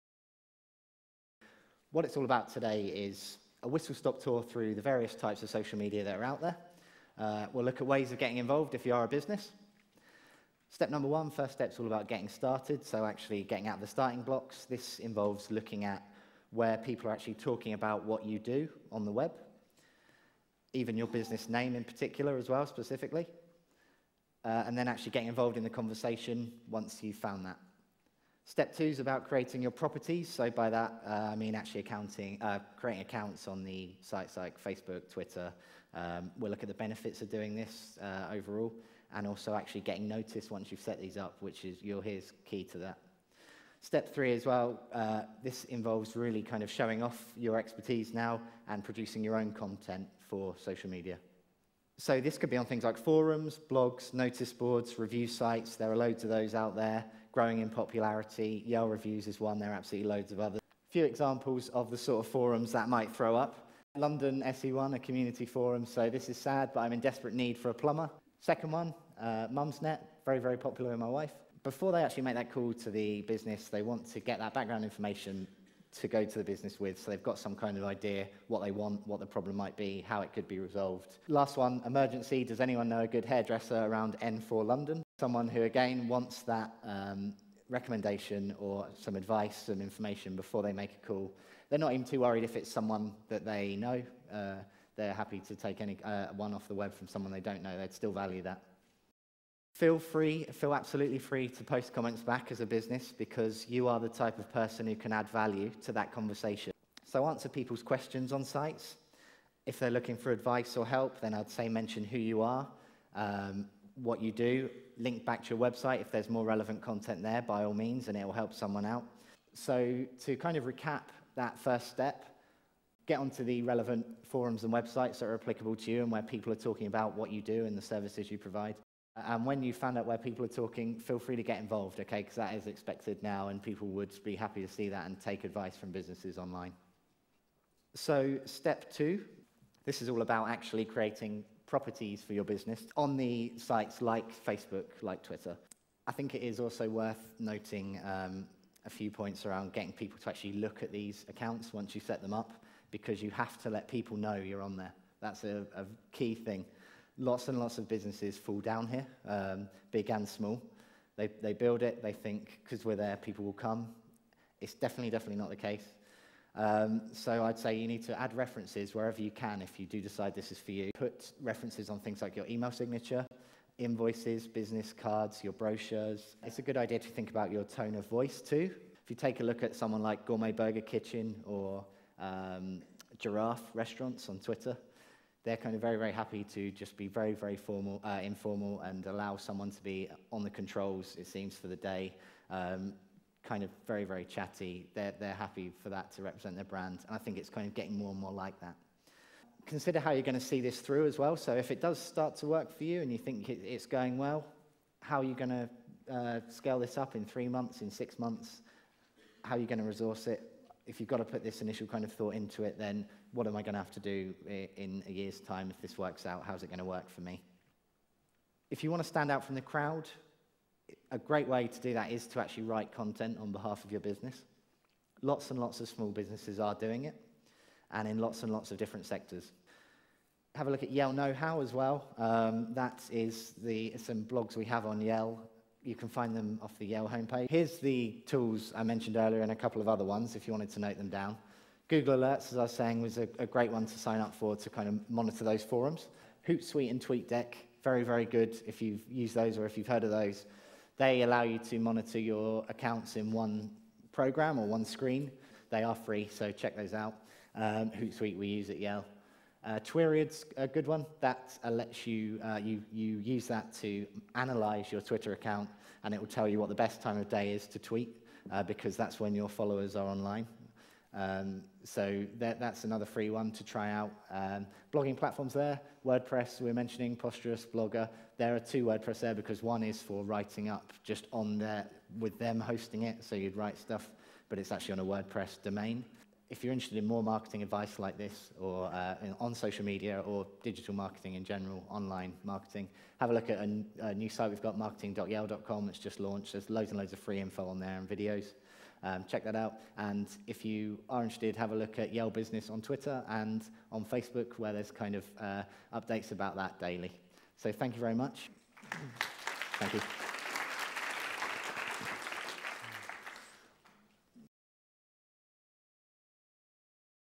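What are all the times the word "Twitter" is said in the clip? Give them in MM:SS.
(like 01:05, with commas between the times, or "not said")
00:35, 02:25, 03:04, 04:25, 05:02.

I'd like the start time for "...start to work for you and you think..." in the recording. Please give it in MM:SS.
03:21.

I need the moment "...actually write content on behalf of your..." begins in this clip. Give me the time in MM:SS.
03:42.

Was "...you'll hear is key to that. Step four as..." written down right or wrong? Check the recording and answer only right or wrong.
wrong.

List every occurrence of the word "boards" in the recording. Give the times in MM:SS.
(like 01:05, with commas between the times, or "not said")
00:54.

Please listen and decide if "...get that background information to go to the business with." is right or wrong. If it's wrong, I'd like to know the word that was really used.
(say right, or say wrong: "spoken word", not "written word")
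right.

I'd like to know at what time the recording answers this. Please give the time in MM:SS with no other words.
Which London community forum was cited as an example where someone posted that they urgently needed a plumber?
01:03.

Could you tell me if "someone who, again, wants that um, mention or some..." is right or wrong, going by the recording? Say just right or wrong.
wrong.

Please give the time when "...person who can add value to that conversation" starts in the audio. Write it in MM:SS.
01:44.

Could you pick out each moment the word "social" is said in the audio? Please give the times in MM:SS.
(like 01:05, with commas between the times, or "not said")
00:05, 00:50, 04:49.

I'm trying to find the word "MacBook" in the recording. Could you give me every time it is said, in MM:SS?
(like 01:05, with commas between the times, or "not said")
not said.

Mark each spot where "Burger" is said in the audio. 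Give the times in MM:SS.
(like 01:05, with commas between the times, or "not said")
03:00.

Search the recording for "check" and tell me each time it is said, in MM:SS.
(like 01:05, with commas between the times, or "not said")
04:16, 04:59.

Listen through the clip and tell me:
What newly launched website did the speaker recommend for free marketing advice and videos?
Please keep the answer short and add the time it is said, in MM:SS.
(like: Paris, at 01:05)
marketing.yell.com, at 04:54.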